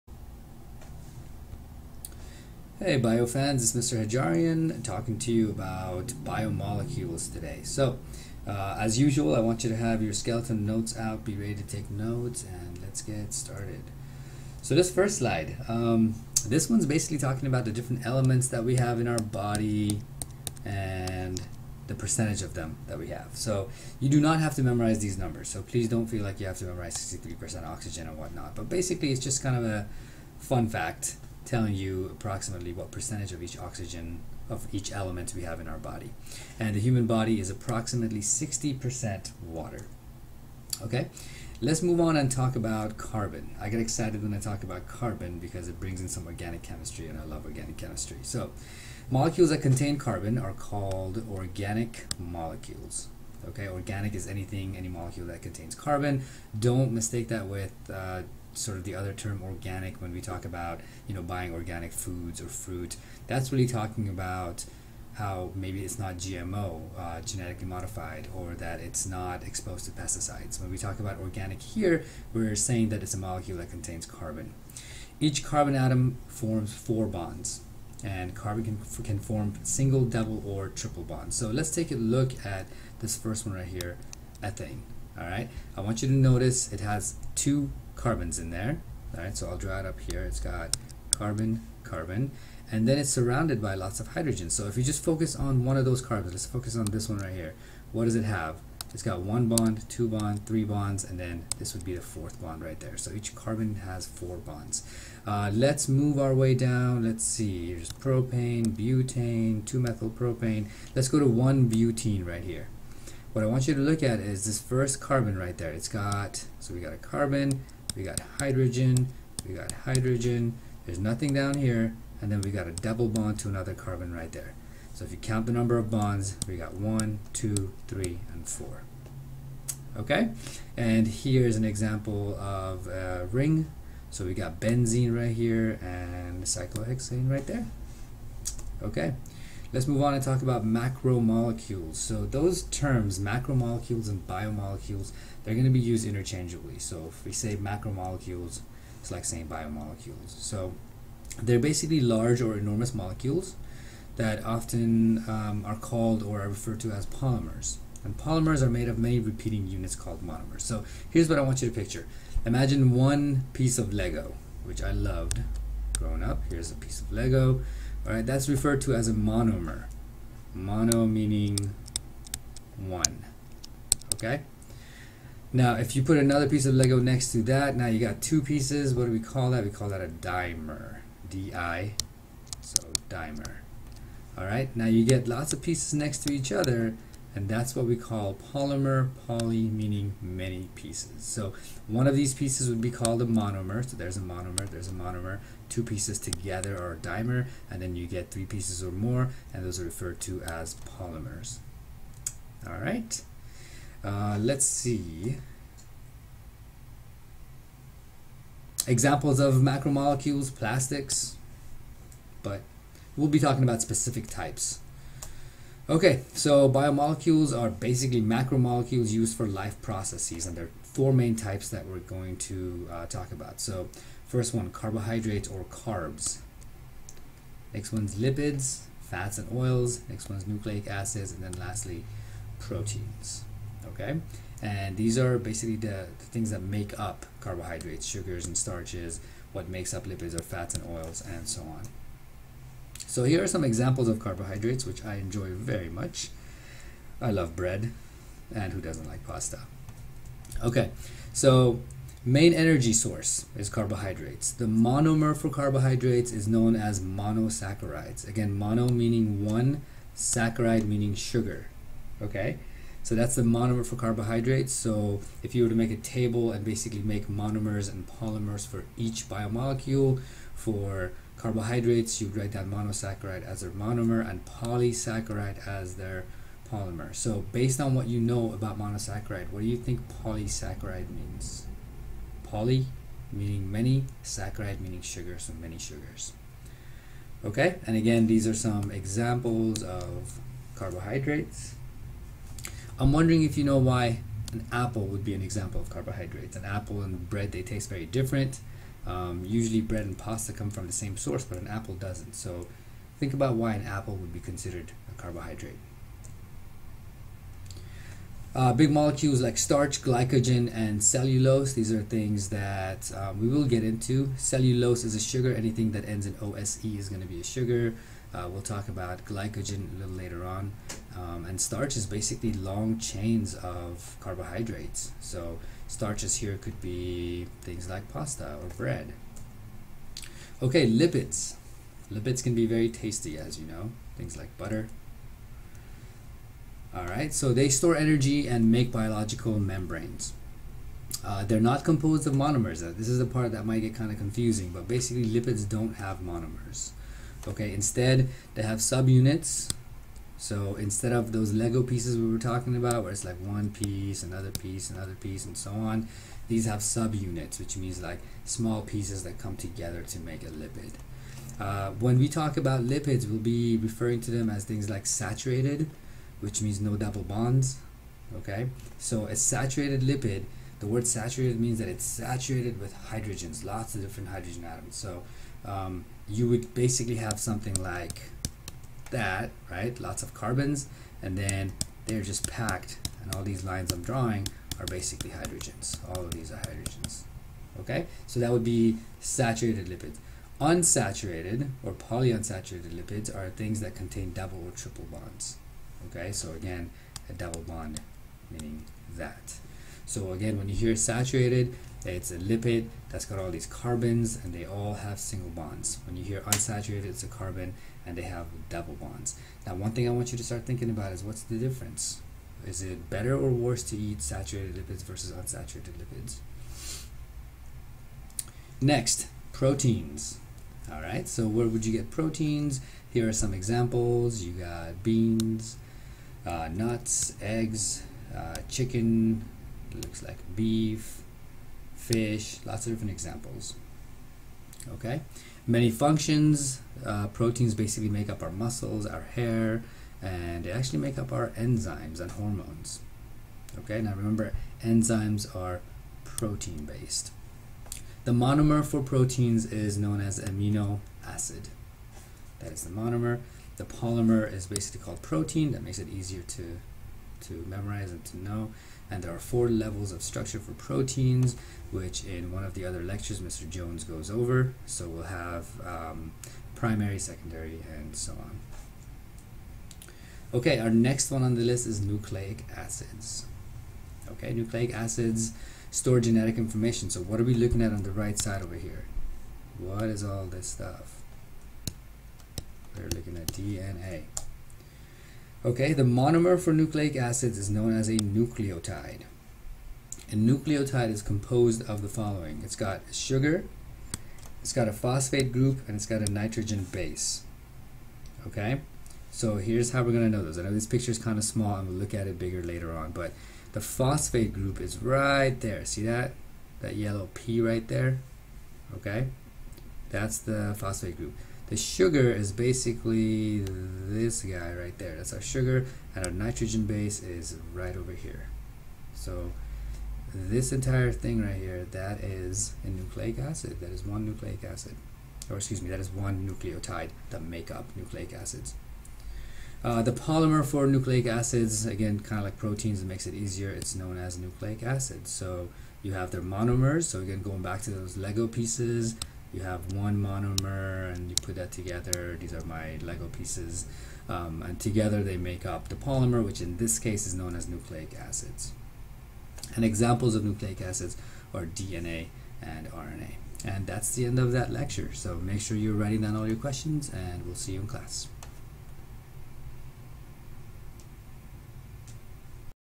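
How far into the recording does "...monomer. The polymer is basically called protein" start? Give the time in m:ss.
7:32.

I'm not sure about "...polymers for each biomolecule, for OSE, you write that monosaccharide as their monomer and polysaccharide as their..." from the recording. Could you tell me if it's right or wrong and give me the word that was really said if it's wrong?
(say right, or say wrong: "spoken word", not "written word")
wrong: "Carbohydrates", not "OSE".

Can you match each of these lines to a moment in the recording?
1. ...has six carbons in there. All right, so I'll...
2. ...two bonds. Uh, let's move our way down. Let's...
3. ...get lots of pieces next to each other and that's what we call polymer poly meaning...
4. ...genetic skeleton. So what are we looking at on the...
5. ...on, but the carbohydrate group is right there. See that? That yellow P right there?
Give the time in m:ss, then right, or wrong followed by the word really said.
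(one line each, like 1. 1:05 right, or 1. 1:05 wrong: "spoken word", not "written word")
1. 1:26 wrong: "two", not "six"
2. 1:44 wrong: "four", not "two"
3. 3:05 right
4. 7:56 wrong: "information", not "skeleton"
5. 8:22 wrong: "phosphate", not "carbohydrate".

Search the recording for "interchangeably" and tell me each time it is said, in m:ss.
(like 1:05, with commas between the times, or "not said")
2:26.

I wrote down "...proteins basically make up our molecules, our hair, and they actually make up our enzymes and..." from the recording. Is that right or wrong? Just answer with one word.
wrong.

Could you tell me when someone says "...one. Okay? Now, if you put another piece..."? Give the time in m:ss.
2:52.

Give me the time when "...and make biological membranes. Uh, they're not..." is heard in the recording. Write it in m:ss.
5:38.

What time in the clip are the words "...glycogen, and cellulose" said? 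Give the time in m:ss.
5:10.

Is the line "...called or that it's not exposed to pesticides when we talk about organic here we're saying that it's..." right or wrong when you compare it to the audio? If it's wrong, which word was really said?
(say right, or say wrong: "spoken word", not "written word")
wrong: "modified", not "called".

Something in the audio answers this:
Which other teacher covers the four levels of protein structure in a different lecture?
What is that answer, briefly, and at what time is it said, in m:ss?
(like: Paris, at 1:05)
Mr. Jones, at 7:43.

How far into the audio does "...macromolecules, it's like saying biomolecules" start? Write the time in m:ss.
2:27.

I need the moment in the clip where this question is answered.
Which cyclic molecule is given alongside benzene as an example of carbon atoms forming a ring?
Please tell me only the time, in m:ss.
2:16.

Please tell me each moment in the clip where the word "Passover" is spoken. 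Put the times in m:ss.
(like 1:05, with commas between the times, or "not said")
not said.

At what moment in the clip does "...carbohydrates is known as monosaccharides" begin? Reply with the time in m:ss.
4:15.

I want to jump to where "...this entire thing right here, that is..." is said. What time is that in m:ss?
8:40.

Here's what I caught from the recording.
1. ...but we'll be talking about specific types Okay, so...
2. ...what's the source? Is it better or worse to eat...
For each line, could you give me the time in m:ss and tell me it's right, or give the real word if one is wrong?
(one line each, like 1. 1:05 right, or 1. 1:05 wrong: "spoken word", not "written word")
1. 3:32 right
2. 6:51 wrong: "difference", not "source".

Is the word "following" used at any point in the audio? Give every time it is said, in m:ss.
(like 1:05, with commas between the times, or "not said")
8:12.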